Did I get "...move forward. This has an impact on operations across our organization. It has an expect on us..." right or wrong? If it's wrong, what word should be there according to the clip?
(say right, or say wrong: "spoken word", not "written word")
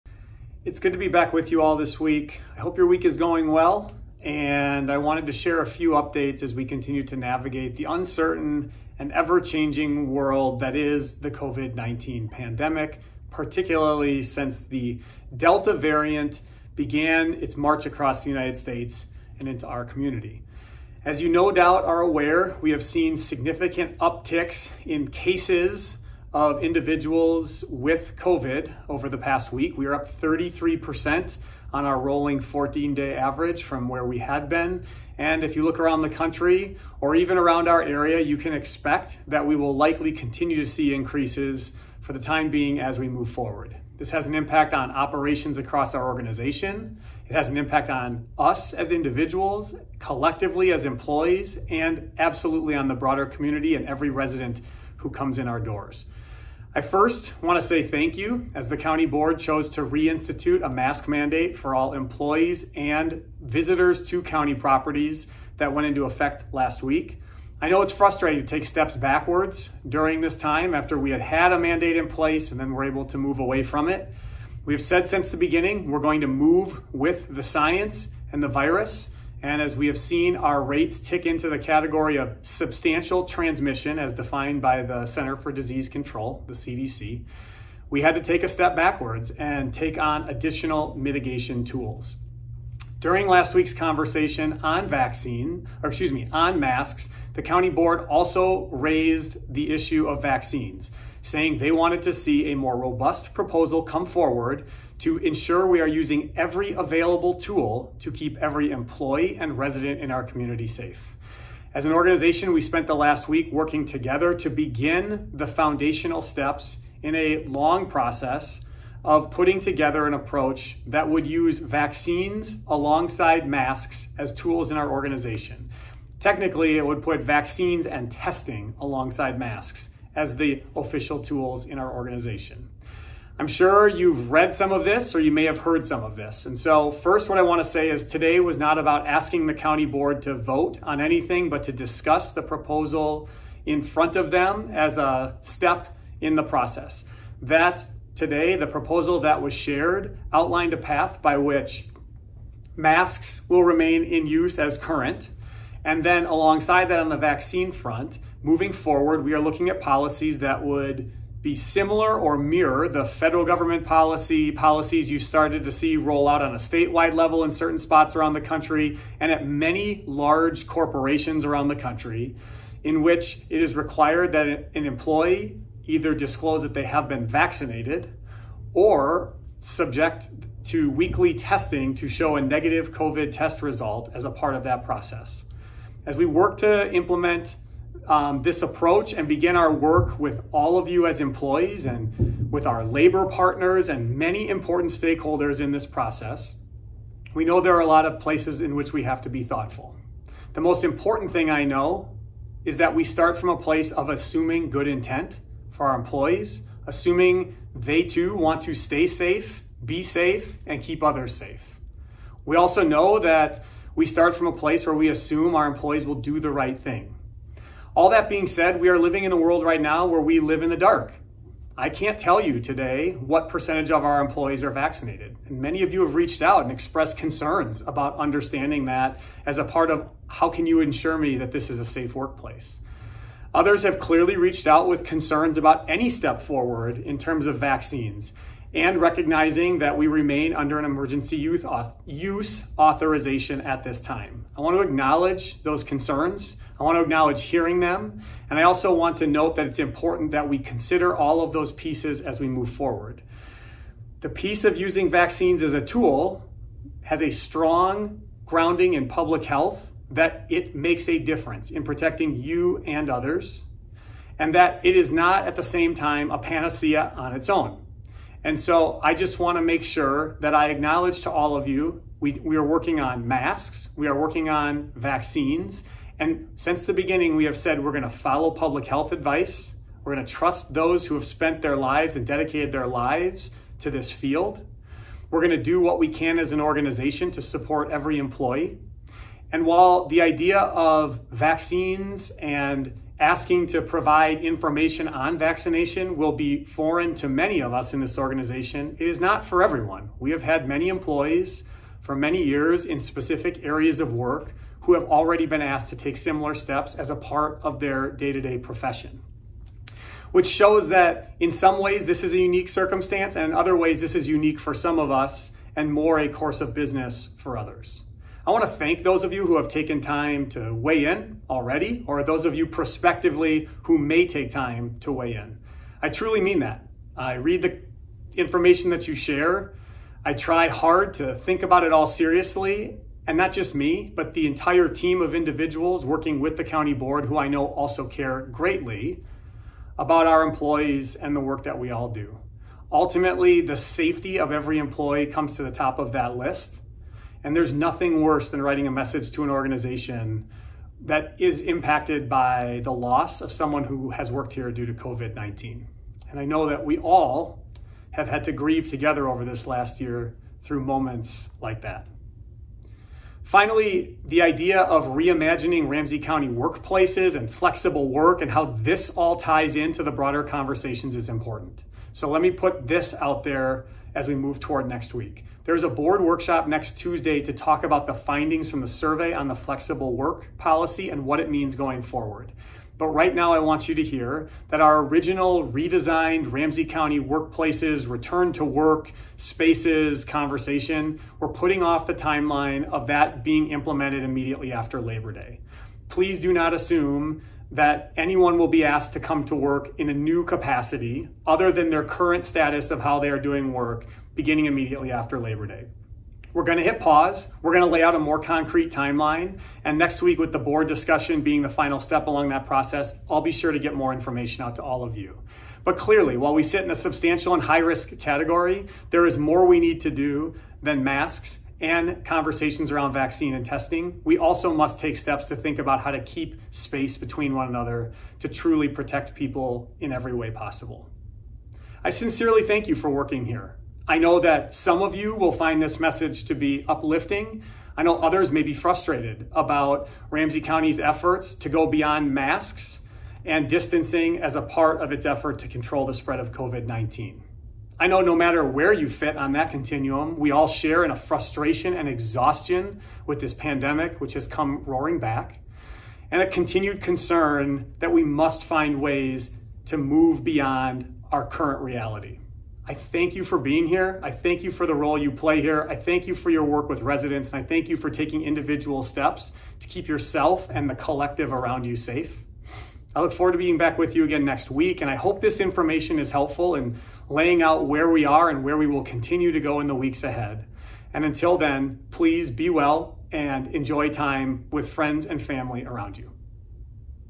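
wrong: "impact", not "expect".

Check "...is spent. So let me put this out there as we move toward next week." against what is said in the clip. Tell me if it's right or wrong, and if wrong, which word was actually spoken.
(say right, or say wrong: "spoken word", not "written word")
wrong: "important", not "spent".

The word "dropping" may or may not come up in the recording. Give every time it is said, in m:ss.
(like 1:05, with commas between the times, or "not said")
not said.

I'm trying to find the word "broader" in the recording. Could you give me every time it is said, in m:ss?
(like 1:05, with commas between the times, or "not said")
0:52, 6:10.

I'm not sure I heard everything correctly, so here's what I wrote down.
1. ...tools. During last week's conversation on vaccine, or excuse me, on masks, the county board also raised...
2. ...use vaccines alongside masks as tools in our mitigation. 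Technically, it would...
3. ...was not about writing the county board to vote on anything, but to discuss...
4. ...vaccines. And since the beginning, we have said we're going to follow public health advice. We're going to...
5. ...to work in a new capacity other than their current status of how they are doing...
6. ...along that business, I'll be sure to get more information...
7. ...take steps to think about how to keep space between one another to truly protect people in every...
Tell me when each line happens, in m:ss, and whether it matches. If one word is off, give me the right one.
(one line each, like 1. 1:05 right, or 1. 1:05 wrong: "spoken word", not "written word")
1. 1:31 right
2. 2:01 wrong: "organization", not "mitigation"
3. 2:18 wrong: "asking", not "writing"
4. 4:34 right
5. 6:39 right
6. 6:52 wrong: "process", not "business"
7. 7:04 right.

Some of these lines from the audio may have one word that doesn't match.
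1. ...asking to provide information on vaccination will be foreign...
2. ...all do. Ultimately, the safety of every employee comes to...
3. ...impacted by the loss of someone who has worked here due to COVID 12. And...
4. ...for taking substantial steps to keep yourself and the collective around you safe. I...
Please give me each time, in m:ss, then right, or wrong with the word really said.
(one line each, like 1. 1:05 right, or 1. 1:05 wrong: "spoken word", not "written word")
1. 4:53 right
2. 5:41 right
3. 5:51 wrong: "19", not "12"
4. 7:47 wrong: "individual", not "substantial".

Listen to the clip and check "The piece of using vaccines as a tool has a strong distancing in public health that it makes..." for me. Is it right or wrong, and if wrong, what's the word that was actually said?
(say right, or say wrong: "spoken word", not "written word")
wrong: "grounding", not "distancing".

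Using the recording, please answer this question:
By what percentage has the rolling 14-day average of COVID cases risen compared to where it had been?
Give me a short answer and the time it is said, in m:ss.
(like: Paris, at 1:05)
33%, at 0:30.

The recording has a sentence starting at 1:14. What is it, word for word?
We've said since the beginning, we're going to move with the science and the virus.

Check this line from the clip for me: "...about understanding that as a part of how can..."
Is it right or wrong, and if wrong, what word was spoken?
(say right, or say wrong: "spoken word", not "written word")
right.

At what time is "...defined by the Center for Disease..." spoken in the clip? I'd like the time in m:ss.
1:24.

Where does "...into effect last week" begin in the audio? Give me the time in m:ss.
1:05.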